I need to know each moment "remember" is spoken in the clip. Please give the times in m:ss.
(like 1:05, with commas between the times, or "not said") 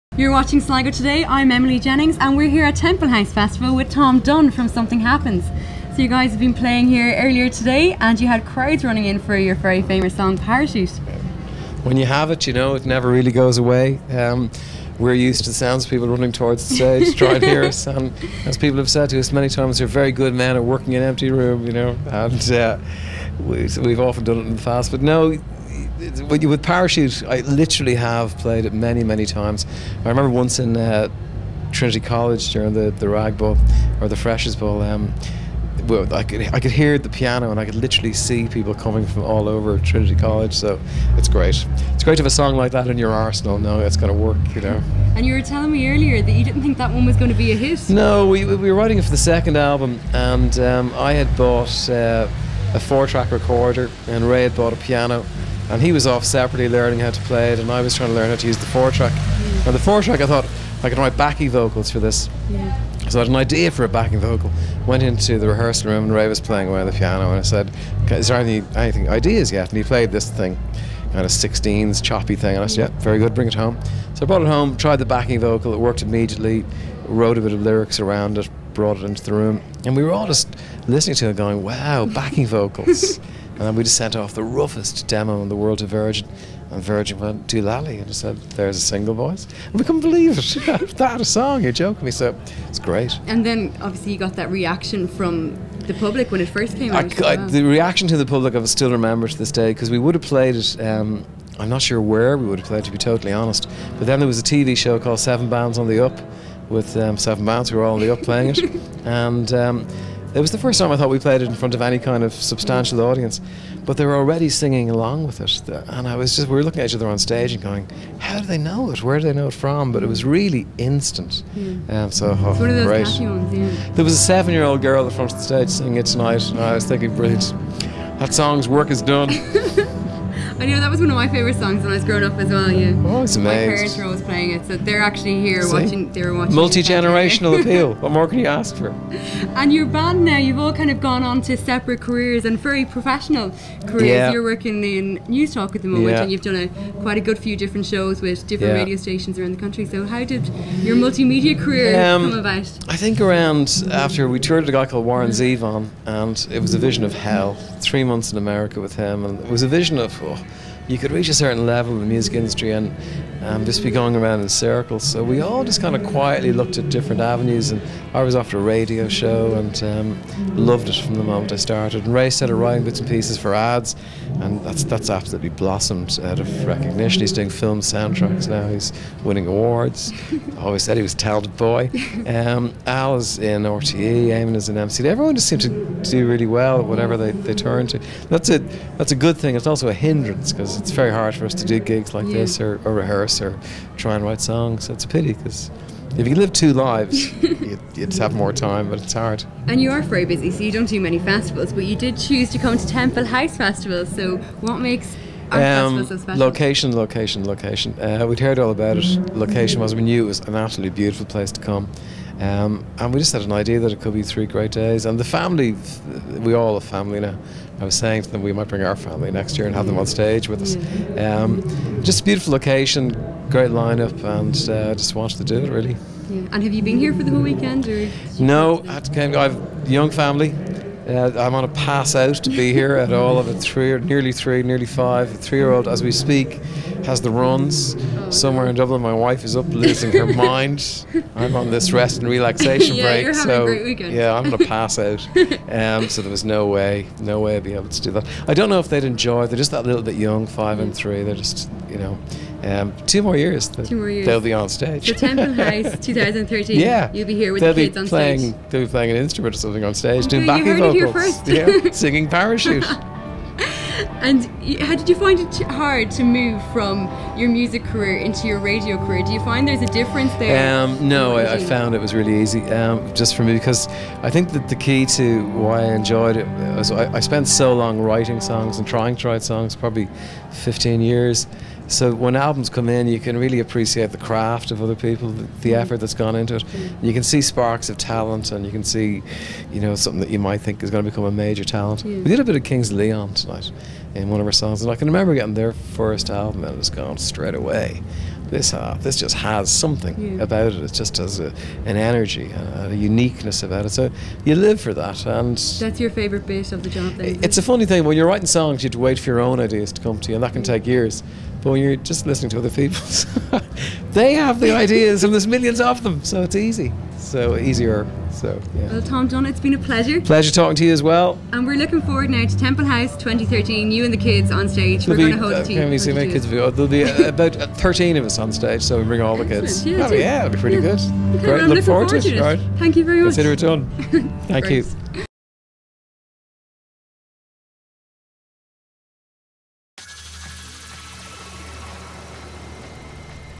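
0:30, 1:38, 4:55.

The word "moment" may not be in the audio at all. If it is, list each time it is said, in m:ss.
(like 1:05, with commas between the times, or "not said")
2:25, 2:51.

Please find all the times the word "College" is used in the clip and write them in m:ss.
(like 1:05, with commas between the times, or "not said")
0:31, 0:40.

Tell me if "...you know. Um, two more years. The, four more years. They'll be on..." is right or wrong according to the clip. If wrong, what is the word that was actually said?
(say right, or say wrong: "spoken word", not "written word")
wrong: "two", not "four".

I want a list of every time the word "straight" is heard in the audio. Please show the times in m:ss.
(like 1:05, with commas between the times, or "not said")
4:57.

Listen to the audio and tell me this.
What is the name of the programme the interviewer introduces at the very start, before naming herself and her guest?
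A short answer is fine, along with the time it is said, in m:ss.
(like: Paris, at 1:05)
Sligo Today, at 0:00.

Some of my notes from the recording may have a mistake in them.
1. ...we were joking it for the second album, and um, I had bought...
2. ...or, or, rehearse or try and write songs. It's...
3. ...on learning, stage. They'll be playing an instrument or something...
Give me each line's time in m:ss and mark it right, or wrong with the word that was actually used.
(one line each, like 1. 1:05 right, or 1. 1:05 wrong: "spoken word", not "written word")
1. 0:48 wrong: "writing", not "joking"
2. 3:12 right
3. 4:17 wrong: "playing", not "learning".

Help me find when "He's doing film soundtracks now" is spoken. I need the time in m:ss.
2:57.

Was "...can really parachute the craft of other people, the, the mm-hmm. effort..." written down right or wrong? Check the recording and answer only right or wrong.
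wrong.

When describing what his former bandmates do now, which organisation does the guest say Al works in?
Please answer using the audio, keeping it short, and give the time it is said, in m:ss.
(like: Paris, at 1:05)
RTE, at 3:03.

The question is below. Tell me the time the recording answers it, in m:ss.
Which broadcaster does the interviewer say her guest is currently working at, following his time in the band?
2:25.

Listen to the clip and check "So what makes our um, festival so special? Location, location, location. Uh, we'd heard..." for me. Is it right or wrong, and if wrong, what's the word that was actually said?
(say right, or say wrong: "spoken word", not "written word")
right.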